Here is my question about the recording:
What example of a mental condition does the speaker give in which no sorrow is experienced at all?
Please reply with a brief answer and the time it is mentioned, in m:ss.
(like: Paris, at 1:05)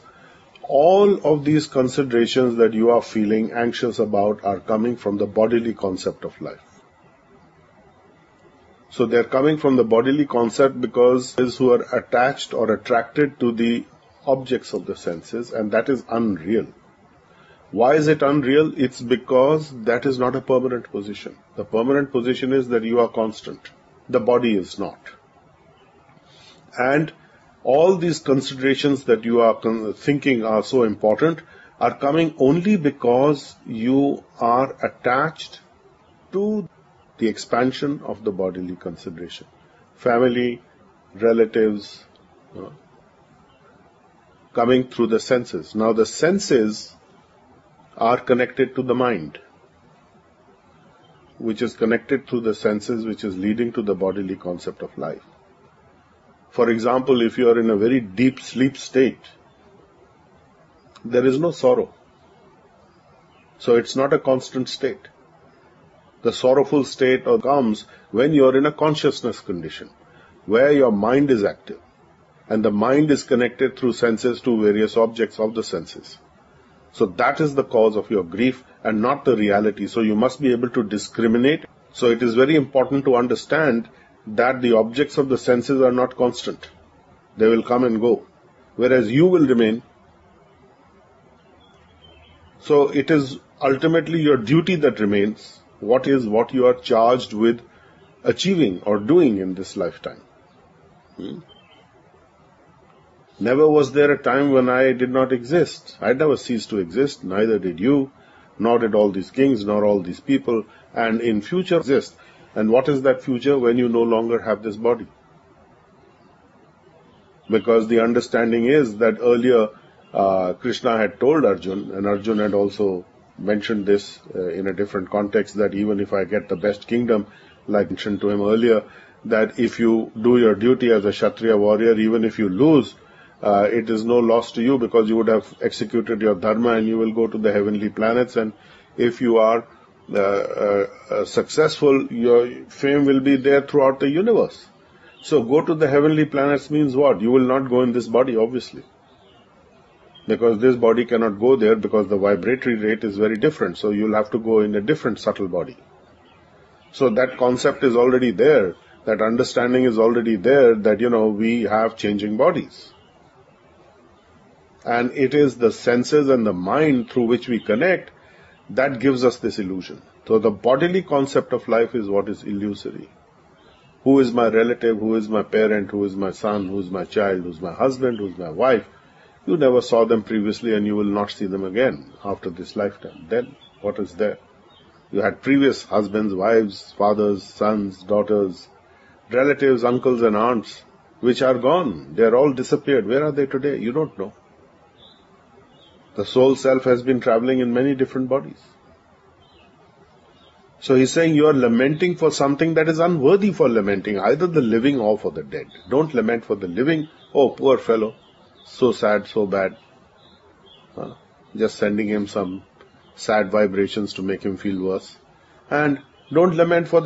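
Deep sleep, at 0:57.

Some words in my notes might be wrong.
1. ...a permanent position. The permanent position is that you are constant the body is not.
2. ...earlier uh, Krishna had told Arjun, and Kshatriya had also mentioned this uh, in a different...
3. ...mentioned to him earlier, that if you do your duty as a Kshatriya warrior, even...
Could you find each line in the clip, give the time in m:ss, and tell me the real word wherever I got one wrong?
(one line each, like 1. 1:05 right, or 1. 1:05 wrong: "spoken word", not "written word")
1. 0:20 right
2. 1:59 wrong: "Arjun", not "Kshatriya"
3. 2:07 right.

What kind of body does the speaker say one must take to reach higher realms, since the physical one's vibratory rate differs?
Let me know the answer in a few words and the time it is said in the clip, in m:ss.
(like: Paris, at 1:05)
Subtle body, at 2:35.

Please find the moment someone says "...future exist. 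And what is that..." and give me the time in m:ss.
1:51.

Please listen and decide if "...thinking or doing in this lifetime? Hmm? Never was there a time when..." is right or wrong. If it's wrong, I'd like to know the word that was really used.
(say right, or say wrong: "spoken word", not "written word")
wrong: "achieving", not "thinking".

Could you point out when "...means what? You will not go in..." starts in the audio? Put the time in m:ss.
2:26.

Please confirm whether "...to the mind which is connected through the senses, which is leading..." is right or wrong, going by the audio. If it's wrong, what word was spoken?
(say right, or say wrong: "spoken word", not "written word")
right.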